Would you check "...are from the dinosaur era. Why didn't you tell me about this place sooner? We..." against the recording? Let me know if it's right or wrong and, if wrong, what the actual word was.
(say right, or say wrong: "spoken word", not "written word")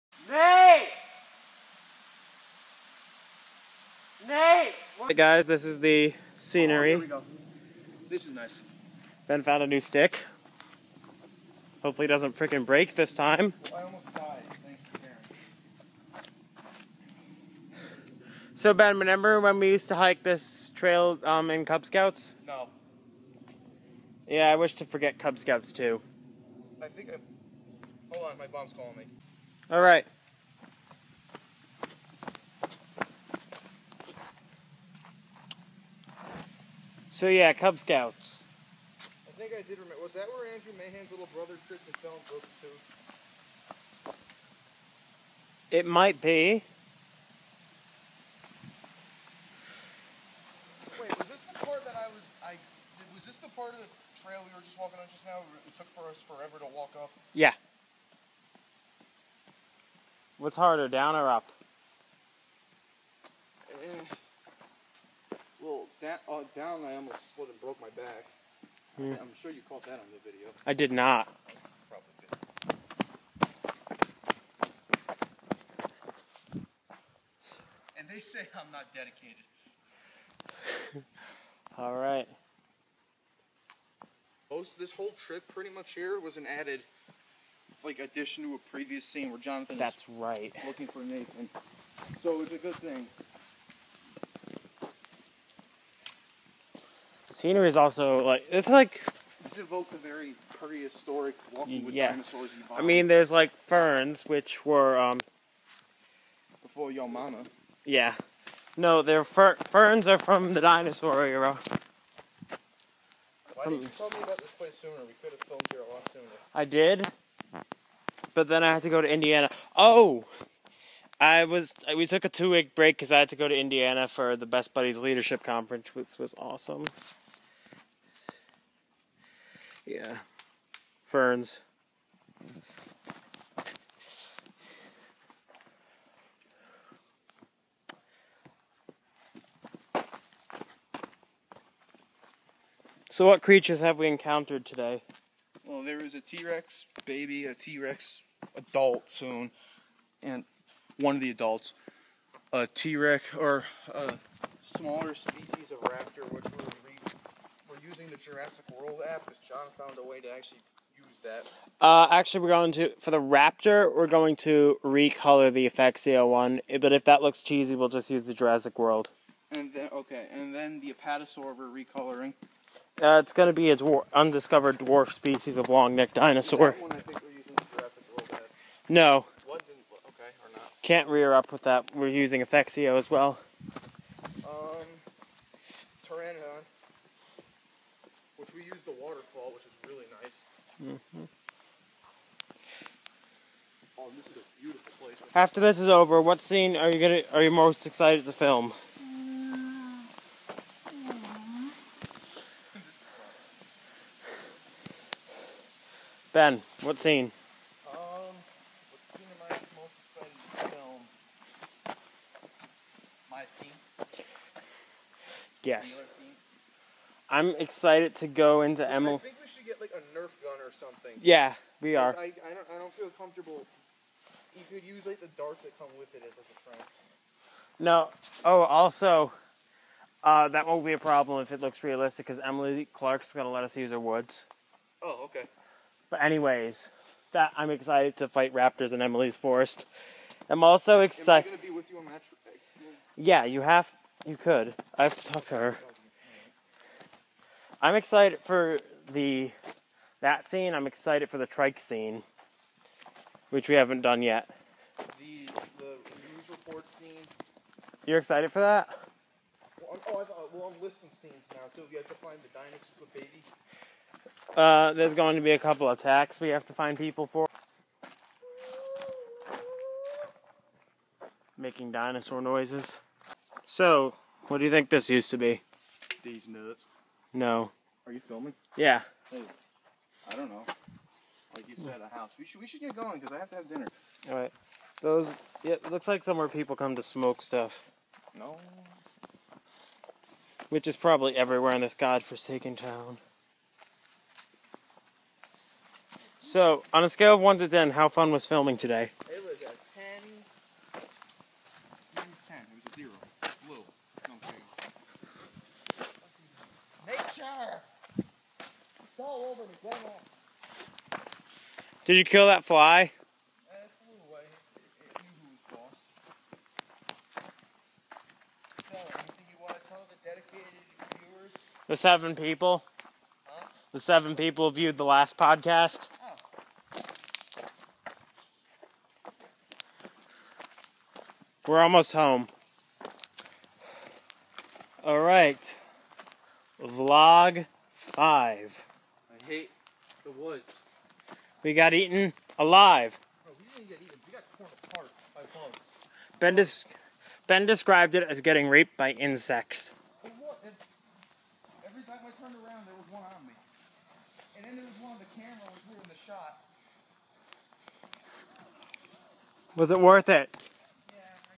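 right.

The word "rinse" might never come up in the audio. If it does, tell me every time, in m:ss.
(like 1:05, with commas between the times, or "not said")
not said.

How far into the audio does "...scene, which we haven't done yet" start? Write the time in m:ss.
4:11.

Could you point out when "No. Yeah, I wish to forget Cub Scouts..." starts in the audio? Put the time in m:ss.
0:22.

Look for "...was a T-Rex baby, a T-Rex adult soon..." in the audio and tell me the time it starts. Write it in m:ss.
2:25.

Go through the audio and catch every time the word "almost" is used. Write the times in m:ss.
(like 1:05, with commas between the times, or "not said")
1:06, 5:31.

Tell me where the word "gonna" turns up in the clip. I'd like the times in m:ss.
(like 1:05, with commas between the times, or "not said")
3:16, 3:53, 4:01.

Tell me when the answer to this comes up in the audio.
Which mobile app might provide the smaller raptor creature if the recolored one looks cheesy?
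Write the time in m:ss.
2:38.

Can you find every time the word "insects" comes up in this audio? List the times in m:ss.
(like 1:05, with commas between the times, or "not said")
5:49.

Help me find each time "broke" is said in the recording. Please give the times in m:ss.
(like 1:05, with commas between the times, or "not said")
0:42, 1:07.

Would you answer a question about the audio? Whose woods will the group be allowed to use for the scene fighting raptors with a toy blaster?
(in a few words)
Emily Clark.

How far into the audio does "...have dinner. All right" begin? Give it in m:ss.
4:43.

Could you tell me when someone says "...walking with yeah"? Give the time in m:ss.
1:41.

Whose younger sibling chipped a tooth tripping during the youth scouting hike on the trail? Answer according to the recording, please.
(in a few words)
Andrew Mahan.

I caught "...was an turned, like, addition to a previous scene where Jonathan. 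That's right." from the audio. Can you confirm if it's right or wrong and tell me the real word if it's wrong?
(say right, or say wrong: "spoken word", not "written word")
wrong: "added", not "turned".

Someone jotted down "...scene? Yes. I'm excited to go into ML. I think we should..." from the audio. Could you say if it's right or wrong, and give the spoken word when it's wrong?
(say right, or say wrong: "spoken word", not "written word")
right.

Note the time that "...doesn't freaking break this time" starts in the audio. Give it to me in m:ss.
0:12.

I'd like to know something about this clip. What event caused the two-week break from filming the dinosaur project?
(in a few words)
Best Buddies Leadership Conference.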